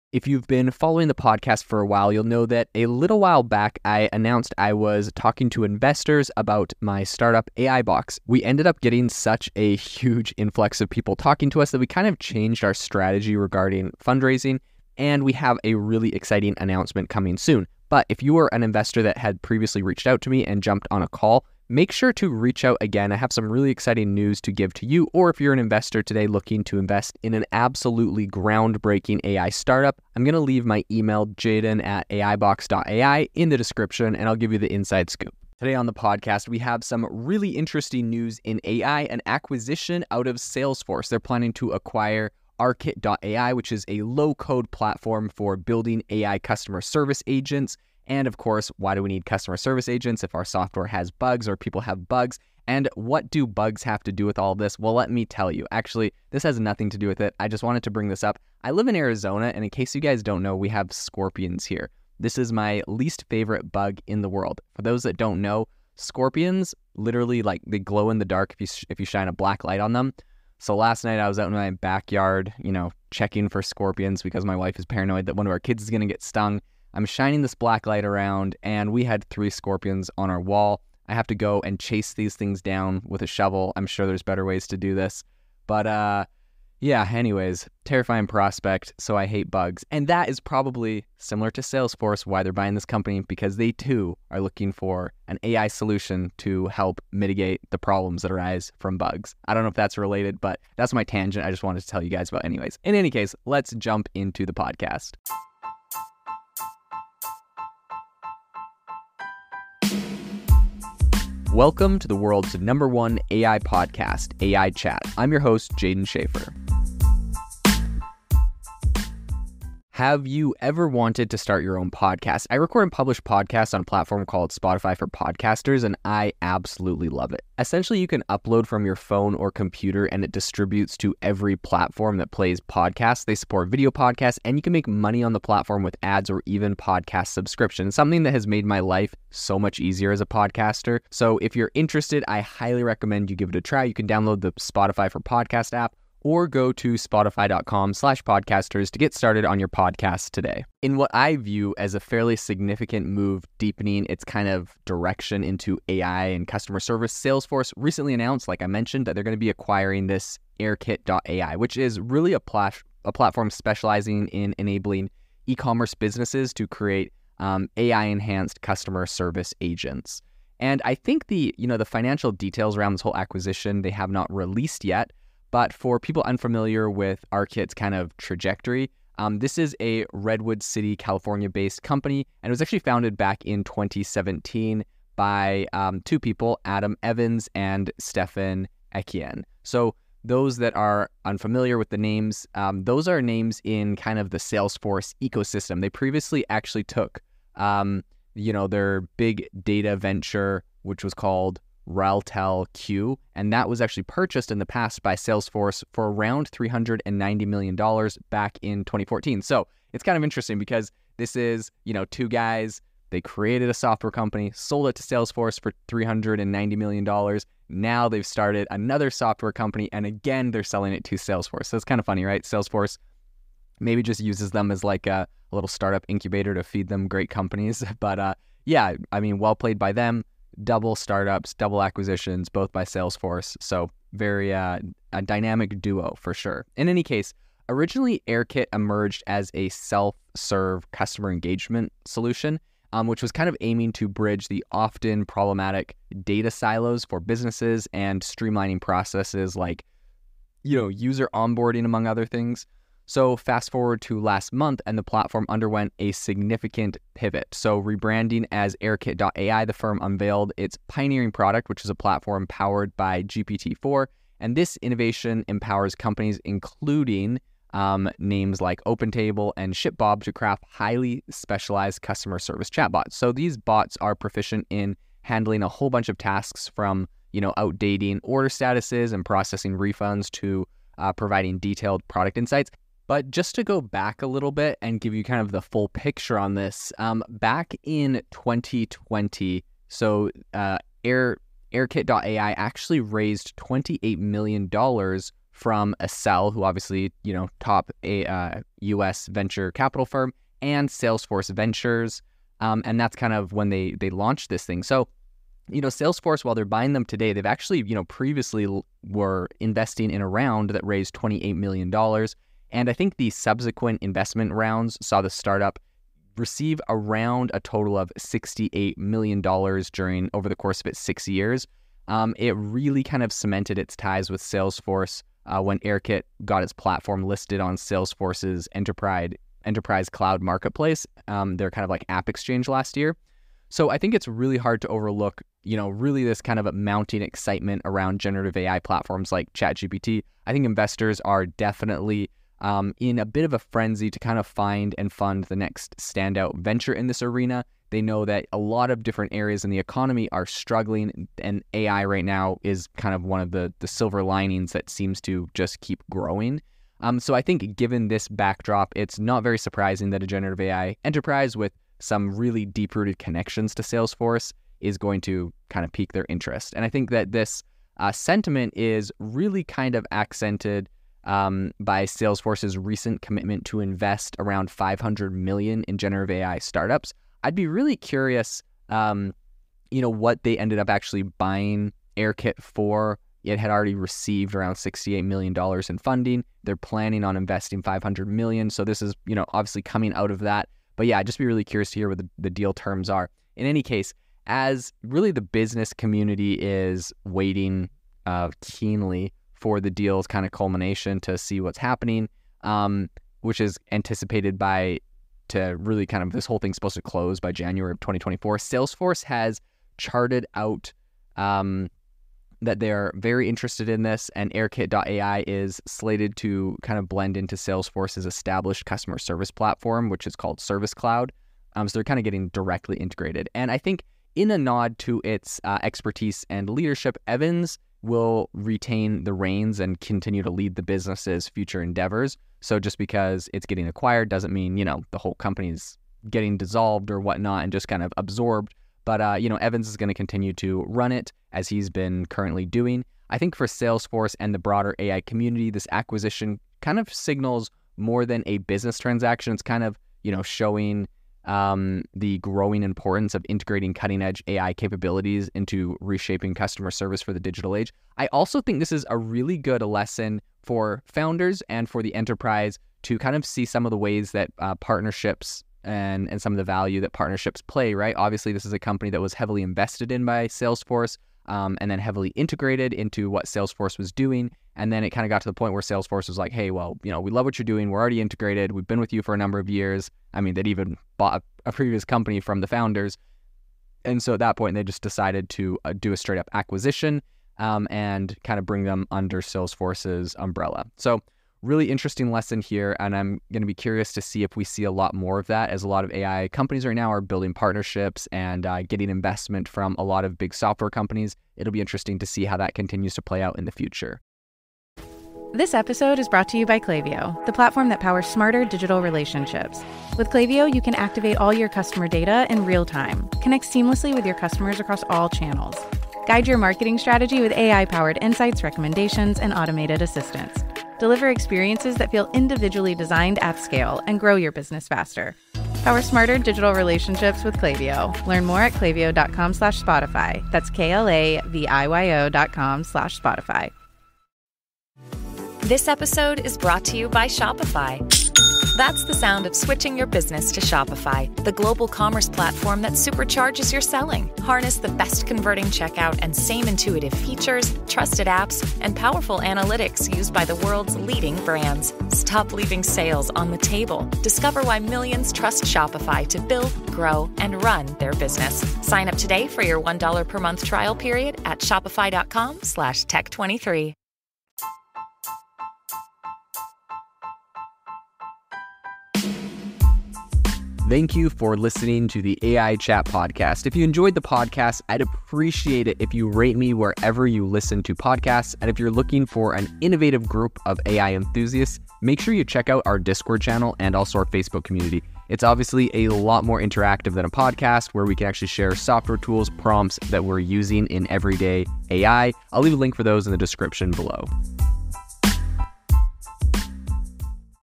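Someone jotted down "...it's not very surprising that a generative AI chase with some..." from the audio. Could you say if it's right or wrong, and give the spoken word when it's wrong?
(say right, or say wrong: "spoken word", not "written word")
wrong: "enterprise", not "chase".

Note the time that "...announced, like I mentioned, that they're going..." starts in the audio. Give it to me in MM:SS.
02:38.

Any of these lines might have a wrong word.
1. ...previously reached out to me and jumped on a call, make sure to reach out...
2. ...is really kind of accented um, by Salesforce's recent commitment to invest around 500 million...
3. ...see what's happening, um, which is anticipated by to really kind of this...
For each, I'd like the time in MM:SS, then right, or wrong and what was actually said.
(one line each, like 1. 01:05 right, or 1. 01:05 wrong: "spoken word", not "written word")
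1. 00:19 right
2. 06:08 right
3. 06:41 right.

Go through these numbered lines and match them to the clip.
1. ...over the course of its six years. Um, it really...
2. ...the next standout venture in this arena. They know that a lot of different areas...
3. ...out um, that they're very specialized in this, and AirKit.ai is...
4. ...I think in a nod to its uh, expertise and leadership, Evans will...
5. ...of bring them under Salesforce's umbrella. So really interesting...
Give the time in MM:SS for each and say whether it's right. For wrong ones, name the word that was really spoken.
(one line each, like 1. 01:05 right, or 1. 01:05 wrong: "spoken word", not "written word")
1. 05:20 right
2. 05:45 right
3. 06:50 wrong: "interested", not "specialized"
4. 07:03 right
5. 08:08 right.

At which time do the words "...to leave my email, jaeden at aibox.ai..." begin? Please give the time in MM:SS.
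00:30.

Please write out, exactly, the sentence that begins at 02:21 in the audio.
So if you're interested, I highly recommend you give it a try.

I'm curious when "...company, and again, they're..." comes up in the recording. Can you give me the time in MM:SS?
03:39.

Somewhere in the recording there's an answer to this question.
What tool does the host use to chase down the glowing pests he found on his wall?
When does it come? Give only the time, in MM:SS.
01:23.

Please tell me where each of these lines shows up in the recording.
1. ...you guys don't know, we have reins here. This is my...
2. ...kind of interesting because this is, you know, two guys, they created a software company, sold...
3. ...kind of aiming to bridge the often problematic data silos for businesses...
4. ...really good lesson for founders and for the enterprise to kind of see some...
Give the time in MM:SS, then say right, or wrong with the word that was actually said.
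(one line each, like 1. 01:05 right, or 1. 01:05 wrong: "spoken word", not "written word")
1. 00:59 wrong: "scorpions", not "reins"
2. 03:30 right
3. 04:03 right
4. 07:39 right.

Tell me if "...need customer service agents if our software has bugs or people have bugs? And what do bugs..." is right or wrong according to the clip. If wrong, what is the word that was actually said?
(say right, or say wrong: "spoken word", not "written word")
right.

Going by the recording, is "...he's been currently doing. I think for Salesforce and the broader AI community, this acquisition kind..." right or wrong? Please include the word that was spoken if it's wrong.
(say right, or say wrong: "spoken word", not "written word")
right.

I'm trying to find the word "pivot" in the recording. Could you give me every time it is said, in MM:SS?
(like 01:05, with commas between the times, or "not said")
04:17.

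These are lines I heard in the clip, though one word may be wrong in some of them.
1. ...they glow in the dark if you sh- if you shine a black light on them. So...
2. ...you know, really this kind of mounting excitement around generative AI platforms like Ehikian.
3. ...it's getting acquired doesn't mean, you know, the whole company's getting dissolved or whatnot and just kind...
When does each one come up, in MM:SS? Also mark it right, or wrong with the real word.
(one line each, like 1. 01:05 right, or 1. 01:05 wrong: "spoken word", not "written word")
1. 01:07 right
2. 05:35 wrong: "ChatGPT", not "Ehikian"
3. 07:13 right.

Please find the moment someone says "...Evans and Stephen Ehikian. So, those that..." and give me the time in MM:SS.
03:07.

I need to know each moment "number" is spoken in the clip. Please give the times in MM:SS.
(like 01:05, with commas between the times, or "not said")
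01:52, 07:59.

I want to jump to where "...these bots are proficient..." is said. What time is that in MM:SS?
04:33.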